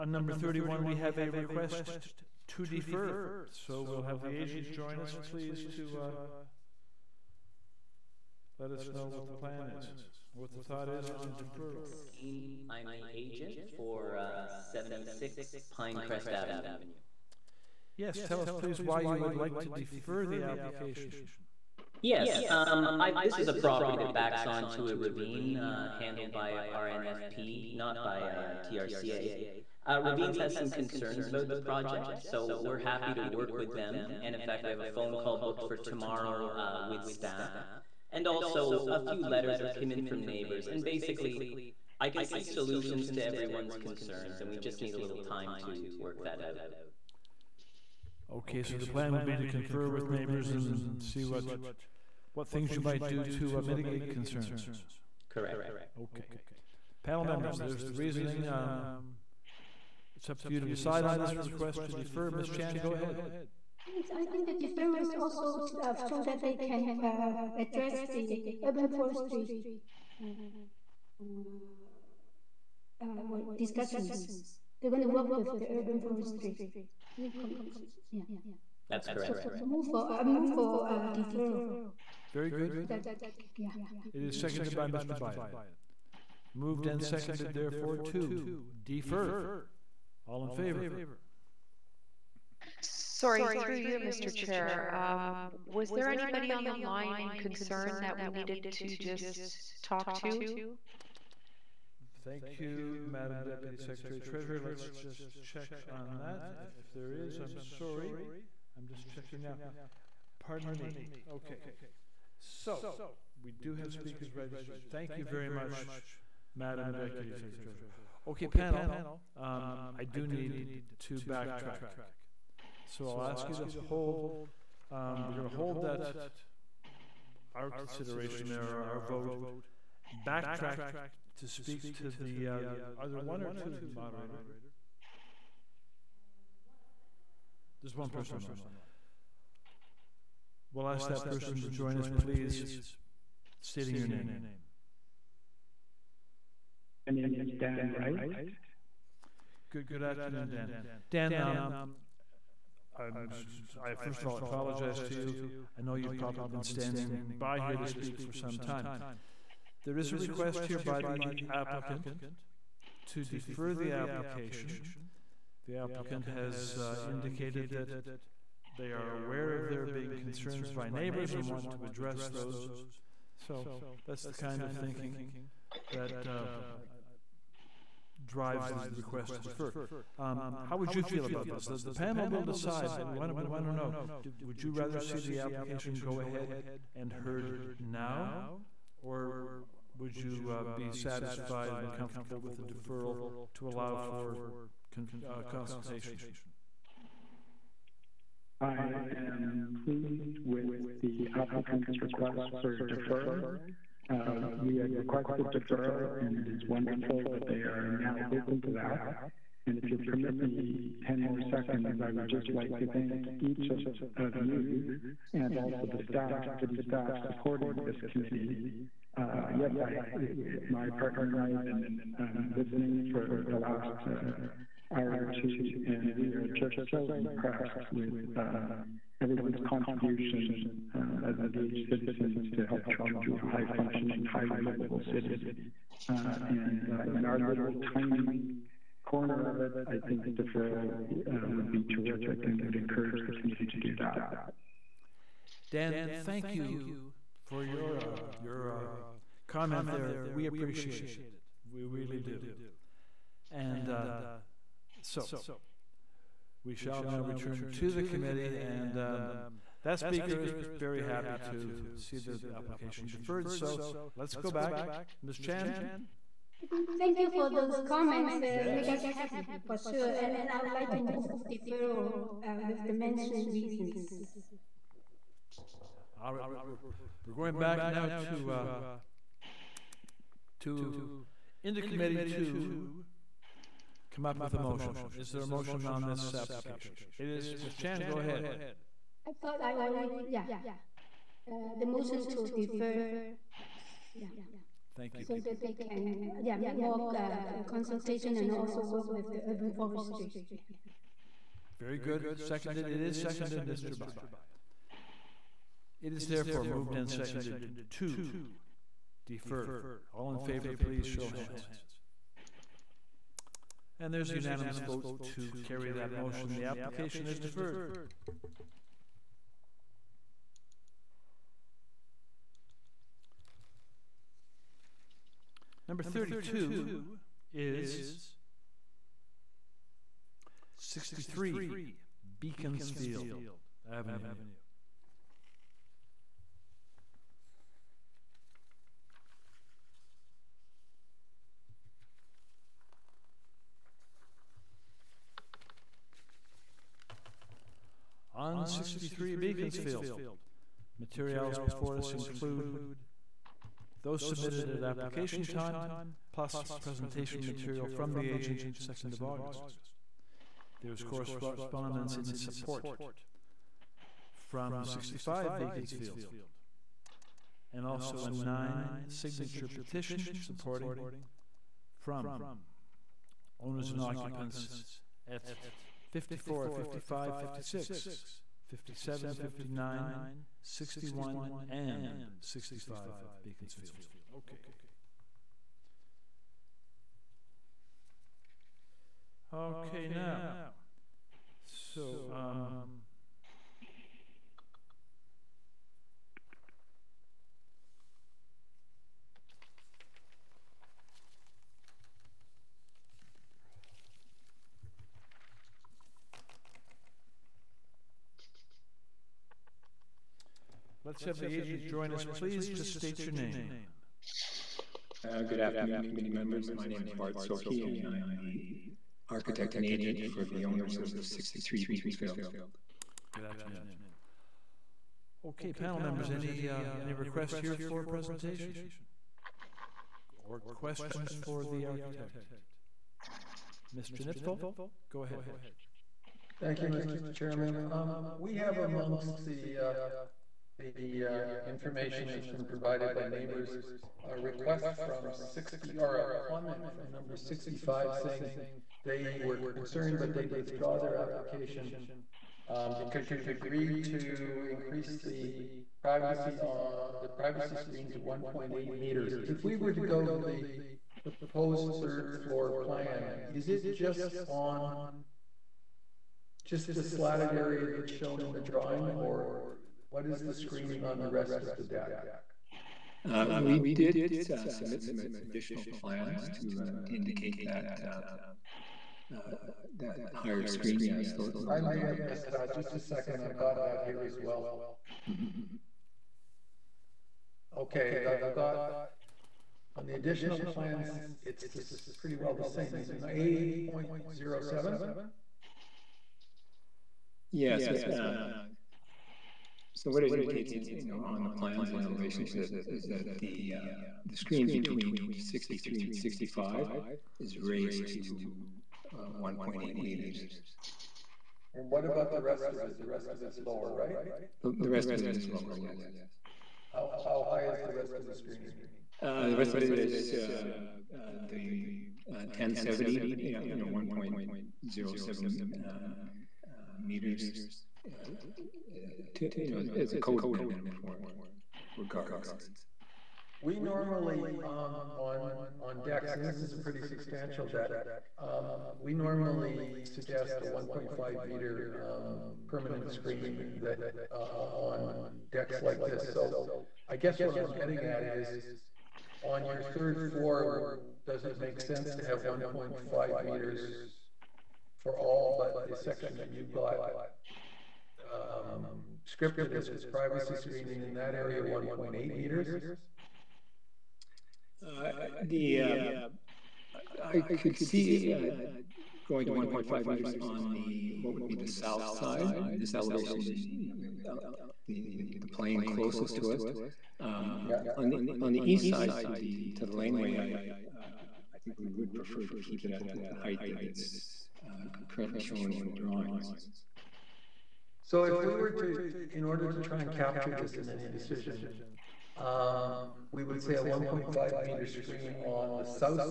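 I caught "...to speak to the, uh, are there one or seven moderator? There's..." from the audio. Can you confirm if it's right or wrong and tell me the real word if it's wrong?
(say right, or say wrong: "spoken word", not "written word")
wrong: "two", not "seven".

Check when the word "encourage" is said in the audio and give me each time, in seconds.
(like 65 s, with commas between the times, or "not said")
242 s.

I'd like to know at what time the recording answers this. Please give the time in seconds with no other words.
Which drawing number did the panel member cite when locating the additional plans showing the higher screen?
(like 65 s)
493 s.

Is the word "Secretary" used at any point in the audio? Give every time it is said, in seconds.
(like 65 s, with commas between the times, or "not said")
103 s, 117 s.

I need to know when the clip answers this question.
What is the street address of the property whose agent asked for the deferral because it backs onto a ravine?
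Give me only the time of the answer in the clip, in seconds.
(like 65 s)
14 s.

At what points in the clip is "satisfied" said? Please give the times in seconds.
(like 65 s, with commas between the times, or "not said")
190 s.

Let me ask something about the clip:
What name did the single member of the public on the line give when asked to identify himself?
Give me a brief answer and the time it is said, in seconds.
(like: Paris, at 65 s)
Dan Wright, at 147 s.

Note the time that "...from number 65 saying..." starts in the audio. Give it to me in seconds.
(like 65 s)
446 s.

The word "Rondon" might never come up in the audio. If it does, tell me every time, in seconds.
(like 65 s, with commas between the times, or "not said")
not said.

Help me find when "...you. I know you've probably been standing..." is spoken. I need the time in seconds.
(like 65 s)
155 s.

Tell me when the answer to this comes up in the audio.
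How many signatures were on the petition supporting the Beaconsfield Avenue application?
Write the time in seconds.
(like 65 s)
368 s.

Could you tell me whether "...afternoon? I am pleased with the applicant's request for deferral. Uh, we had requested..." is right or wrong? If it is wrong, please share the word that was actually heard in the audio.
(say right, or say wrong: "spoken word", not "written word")
wrong: "consultation", not "afternoon".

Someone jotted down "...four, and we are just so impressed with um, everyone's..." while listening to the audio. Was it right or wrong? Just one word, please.
wrong.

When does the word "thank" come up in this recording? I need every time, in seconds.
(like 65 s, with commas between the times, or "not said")
102 s, 114 s, 212 s, 246 s, 266 s, 294 s, 436 s.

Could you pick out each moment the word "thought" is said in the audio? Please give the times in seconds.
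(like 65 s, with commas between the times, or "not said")
10 s, 289 s.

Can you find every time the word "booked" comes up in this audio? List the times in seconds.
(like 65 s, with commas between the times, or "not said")
35 s.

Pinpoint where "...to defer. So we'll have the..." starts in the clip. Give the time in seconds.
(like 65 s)
2 s.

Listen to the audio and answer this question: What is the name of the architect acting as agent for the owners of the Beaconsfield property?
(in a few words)
Bart Soki.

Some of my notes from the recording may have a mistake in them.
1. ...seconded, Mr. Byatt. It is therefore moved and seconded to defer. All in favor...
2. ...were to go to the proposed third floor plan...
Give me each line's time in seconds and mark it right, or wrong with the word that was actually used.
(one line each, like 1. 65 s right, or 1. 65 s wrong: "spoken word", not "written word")
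1. 303 s right
2. 459 s right.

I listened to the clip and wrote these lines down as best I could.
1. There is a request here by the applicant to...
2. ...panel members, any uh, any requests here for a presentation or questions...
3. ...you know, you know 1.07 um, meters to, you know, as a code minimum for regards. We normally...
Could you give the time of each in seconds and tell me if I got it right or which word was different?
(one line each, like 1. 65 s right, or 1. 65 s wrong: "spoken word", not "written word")
1. 159 s right
2. 425 s right
3. 523 s right.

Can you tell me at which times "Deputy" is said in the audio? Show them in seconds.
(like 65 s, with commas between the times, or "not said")
103 s, 116 s.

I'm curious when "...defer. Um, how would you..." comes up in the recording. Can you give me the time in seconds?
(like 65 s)
179 s.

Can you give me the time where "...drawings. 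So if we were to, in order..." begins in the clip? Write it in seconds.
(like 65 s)
585 s.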